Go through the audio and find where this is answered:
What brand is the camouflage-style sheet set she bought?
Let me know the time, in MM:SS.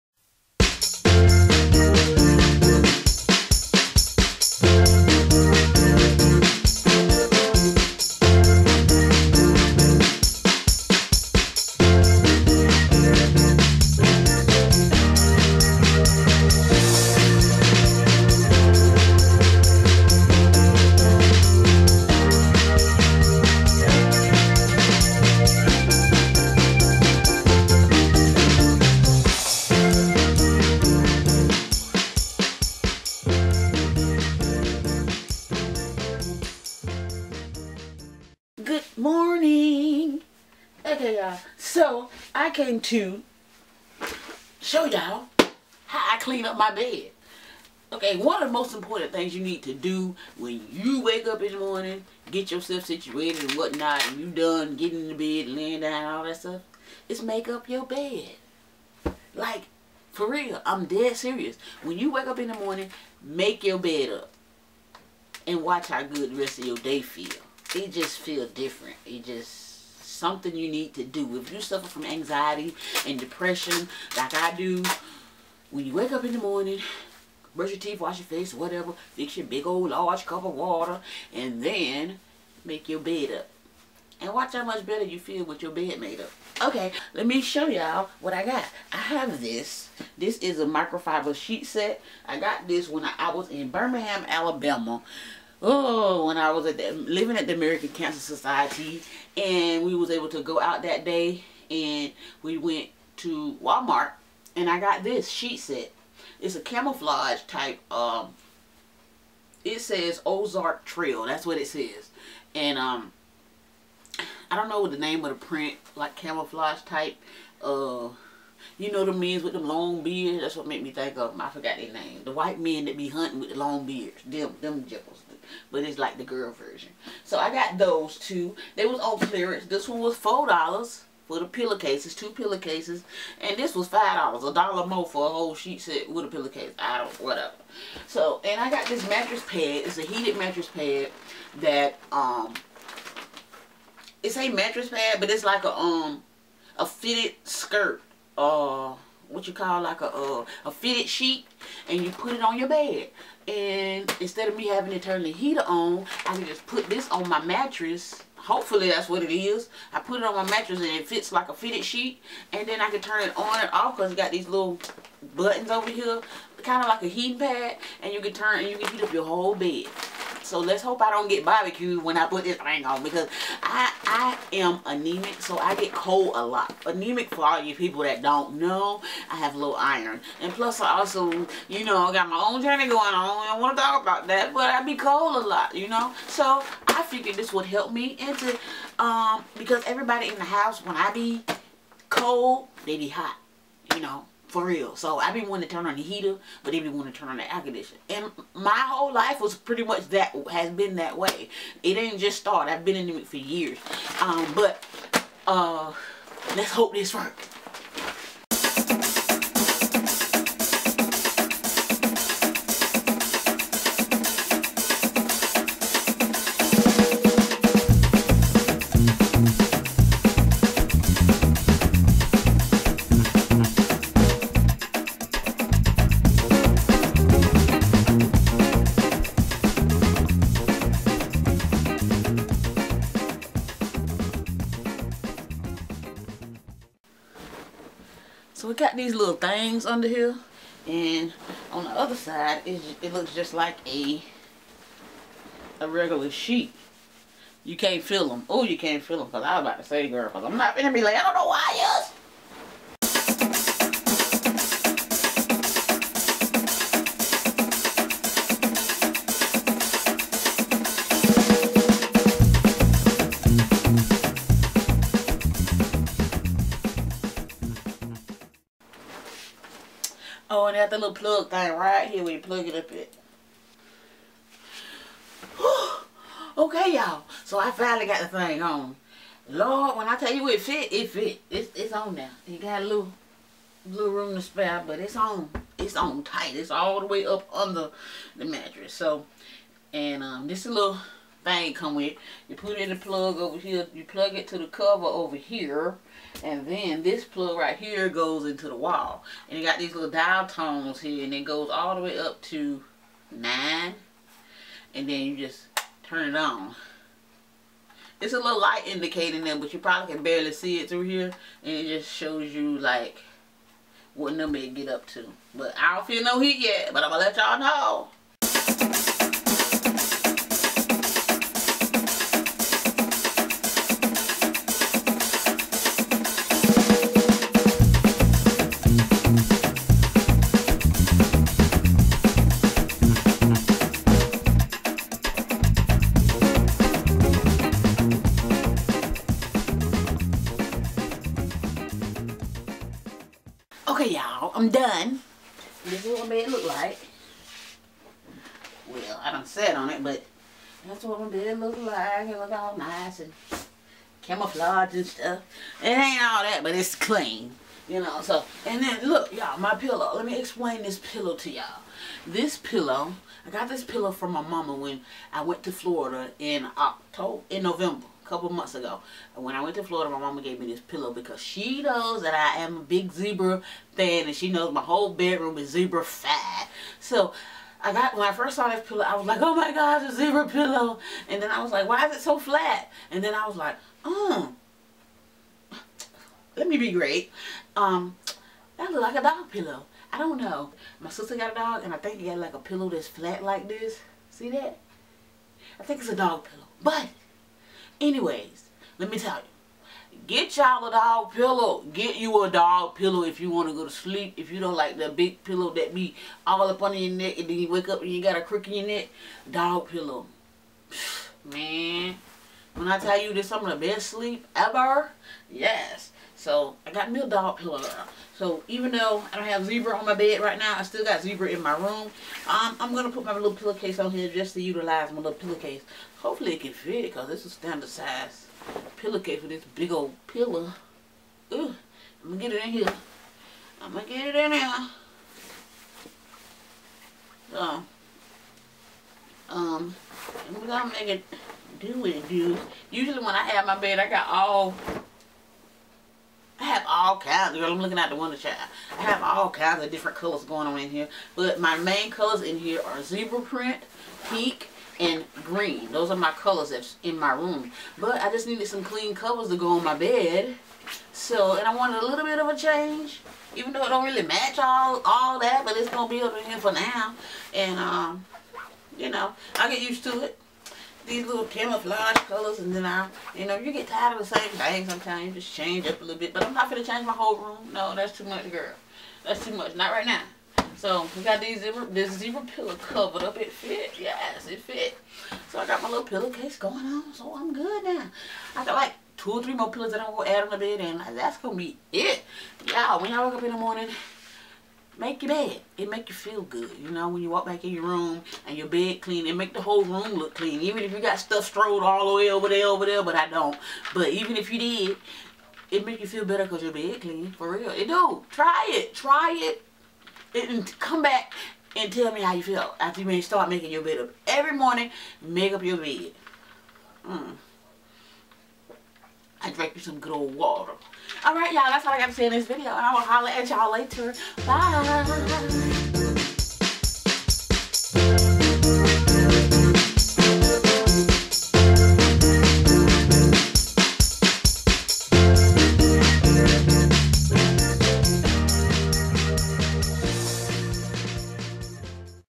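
01:50.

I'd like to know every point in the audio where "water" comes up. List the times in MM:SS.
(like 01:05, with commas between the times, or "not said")
01:20, 08:40.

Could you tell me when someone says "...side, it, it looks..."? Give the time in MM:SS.
04:02.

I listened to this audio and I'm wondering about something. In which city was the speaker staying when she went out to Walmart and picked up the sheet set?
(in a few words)
Birmingham, Alabama.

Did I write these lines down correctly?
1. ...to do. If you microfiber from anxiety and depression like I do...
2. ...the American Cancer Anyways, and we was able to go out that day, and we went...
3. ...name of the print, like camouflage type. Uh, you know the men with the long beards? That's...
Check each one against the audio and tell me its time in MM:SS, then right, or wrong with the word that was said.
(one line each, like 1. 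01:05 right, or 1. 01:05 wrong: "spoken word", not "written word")
1. 01:10 wrong: "suffer", not "microfiber"
2. 01:37 wrong: "Society", not "Anyways"
3. 01:54 right.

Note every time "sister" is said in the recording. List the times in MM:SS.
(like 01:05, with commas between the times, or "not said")
06:31.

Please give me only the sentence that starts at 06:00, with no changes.
Let me explain this pillow to y'all.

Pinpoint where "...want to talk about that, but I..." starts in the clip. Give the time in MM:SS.
03:03.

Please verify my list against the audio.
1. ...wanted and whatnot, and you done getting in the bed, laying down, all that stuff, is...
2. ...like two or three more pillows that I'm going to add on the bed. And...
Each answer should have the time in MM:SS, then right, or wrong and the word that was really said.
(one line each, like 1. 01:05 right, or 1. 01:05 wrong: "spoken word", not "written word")
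1. 00:52 wrong: "situated", not "wanted"
2. 08:08 right.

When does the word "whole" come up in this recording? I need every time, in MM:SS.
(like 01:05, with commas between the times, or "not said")
02:15, 02:49, 03:18, 06:14, 07:57, 08:19.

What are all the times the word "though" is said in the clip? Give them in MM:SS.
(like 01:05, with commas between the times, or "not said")
06:58, 07:43.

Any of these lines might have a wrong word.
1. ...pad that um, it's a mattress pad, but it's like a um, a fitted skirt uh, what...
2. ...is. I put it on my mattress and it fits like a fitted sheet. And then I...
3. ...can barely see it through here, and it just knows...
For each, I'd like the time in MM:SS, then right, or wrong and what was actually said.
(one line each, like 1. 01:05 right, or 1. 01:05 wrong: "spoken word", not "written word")
1. 02:20 right
2. 02:39 right
3. 05:10 wrong: "shows", not "knows".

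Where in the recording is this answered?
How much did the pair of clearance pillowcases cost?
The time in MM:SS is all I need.
02:10.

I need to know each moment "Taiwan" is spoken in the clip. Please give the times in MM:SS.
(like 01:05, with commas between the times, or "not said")
not said.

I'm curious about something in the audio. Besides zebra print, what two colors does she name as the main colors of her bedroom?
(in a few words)
pink and green.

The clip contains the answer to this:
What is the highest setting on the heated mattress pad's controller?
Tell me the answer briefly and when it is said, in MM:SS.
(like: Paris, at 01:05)
9, at 05:03.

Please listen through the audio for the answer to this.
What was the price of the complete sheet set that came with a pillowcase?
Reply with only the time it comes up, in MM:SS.
02:13.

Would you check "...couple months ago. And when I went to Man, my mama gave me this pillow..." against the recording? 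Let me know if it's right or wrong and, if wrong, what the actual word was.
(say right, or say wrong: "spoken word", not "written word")
wrong: "Florida", not "Man".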